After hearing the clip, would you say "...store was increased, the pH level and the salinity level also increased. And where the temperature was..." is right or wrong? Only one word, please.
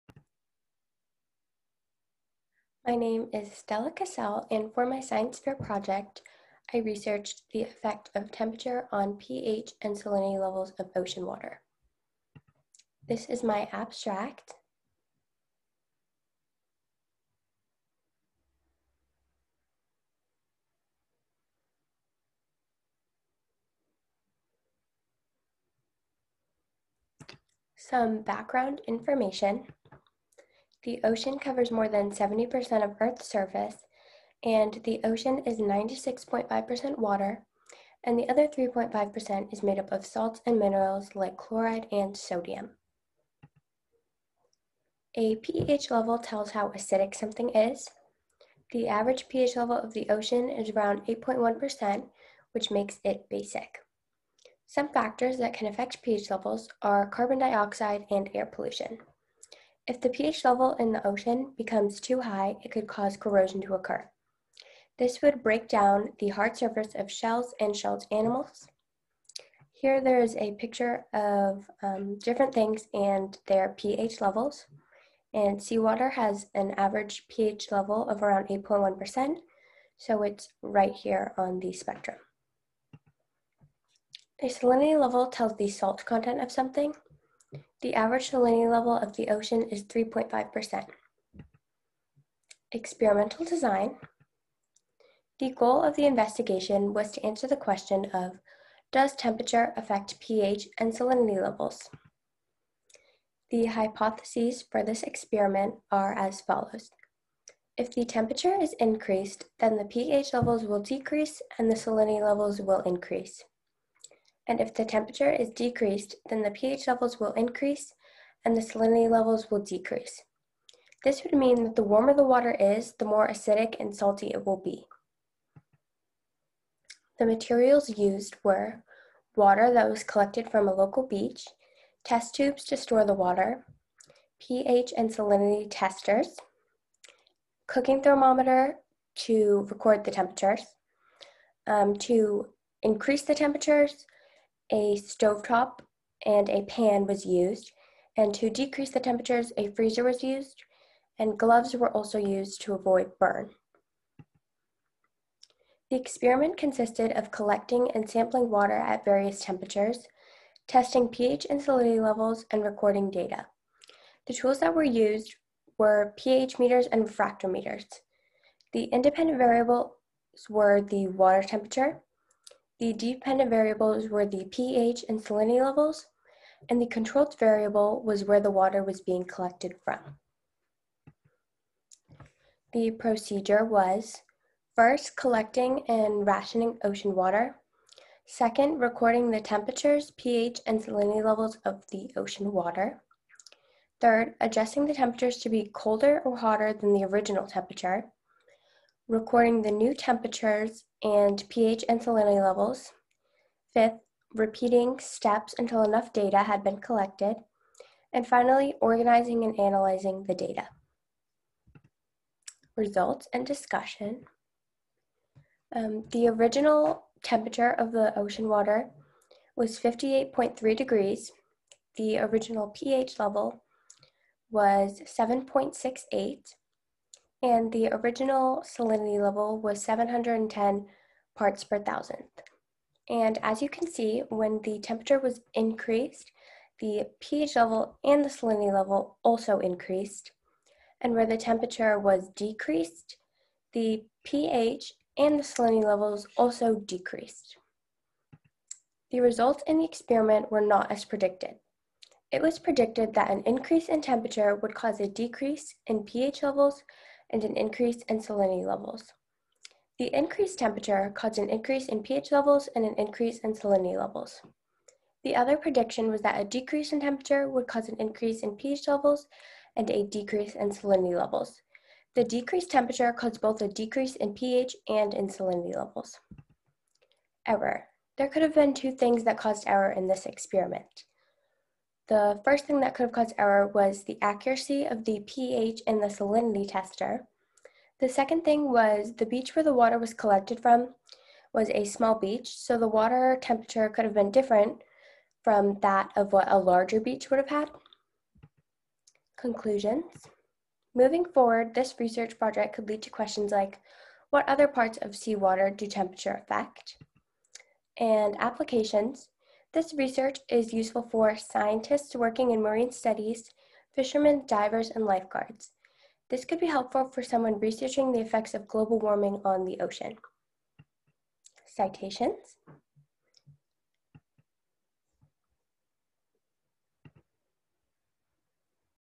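wrong.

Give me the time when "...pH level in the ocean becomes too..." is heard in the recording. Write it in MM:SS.
01:00.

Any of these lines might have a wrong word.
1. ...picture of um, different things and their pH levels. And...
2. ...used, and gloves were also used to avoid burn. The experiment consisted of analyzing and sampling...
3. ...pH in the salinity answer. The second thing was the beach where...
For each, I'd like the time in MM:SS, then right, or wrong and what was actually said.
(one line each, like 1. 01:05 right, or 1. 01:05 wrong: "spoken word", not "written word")
1. 01:10 right
2. 02:30 wrong: "collecting", not "analyzing"
3. 04:45 wrong: "tester", not "answer".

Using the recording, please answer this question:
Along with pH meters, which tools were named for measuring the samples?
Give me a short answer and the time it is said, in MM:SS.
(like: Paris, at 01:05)
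refractometers, at 02:47.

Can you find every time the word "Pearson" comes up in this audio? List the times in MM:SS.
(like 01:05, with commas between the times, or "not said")
not said.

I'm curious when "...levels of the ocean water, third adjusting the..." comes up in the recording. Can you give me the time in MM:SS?
03:11.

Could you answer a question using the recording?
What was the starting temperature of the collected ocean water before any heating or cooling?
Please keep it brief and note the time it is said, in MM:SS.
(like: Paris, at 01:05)
58.3 degrees, at 03:39.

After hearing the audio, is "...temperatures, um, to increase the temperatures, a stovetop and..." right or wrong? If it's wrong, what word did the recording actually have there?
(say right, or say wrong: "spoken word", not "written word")
right.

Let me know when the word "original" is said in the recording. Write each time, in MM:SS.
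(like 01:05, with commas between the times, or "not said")
03:17, 03:36, 03:42, 03:47.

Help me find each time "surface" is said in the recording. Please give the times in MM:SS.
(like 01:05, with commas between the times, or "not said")
00:33, 01:06.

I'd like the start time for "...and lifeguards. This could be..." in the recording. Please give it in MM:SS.
05:14.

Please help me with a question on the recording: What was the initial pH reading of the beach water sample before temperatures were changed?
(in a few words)
7.68.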